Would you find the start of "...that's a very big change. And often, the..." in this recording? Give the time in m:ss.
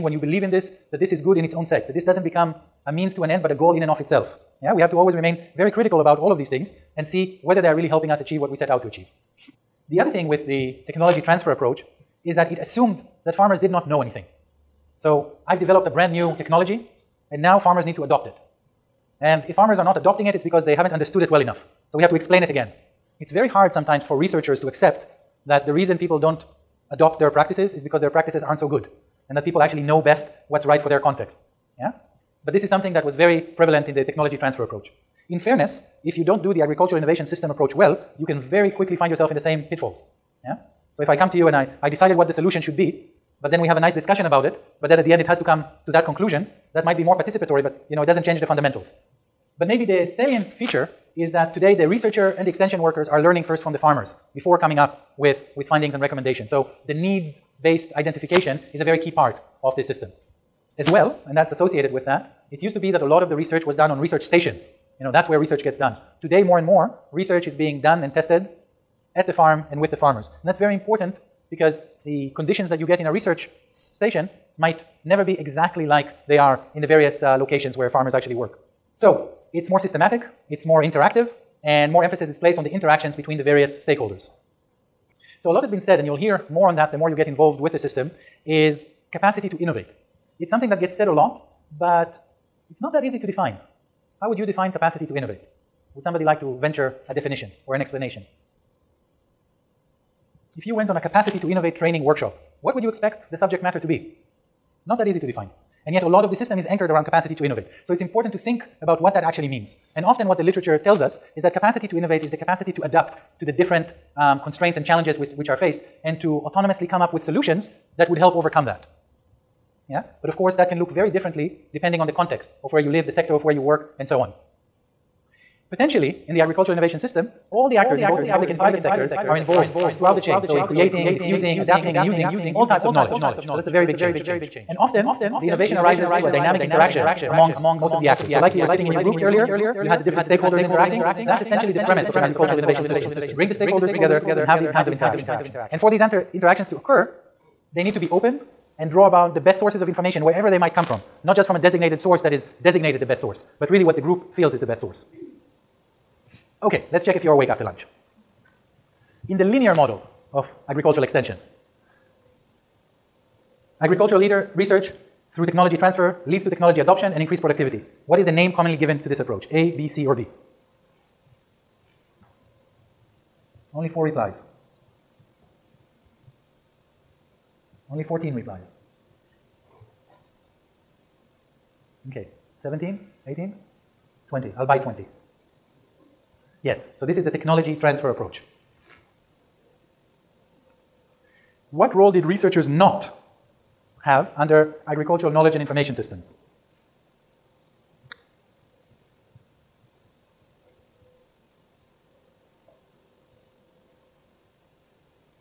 2:13.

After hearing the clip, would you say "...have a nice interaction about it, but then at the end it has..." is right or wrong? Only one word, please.
wrong.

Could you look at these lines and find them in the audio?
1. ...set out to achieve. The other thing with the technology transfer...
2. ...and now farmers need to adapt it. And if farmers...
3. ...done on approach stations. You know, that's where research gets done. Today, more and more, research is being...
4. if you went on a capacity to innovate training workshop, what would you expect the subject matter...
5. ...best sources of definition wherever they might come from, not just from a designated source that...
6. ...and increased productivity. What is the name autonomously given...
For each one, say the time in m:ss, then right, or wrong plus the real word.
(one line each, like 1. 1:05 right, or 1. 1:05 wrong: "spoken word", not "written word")
1. 0:08 right
2. 0:17 wrong: "adopt", not "adapt"
3. 1:03 wrong: "research", not "approach"
4. 1:40 right
5. 2:29 wrong: "information", not "definition"
6. 2:47 wrong: "commonly", not "autonomously".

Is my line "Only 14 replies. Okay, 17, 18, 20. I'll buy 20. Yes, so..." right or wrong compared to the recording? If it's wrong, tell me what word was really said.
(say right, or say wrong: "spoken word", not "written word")
right.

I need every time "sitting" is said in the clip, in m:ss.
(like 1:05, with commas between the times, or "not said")
2:18.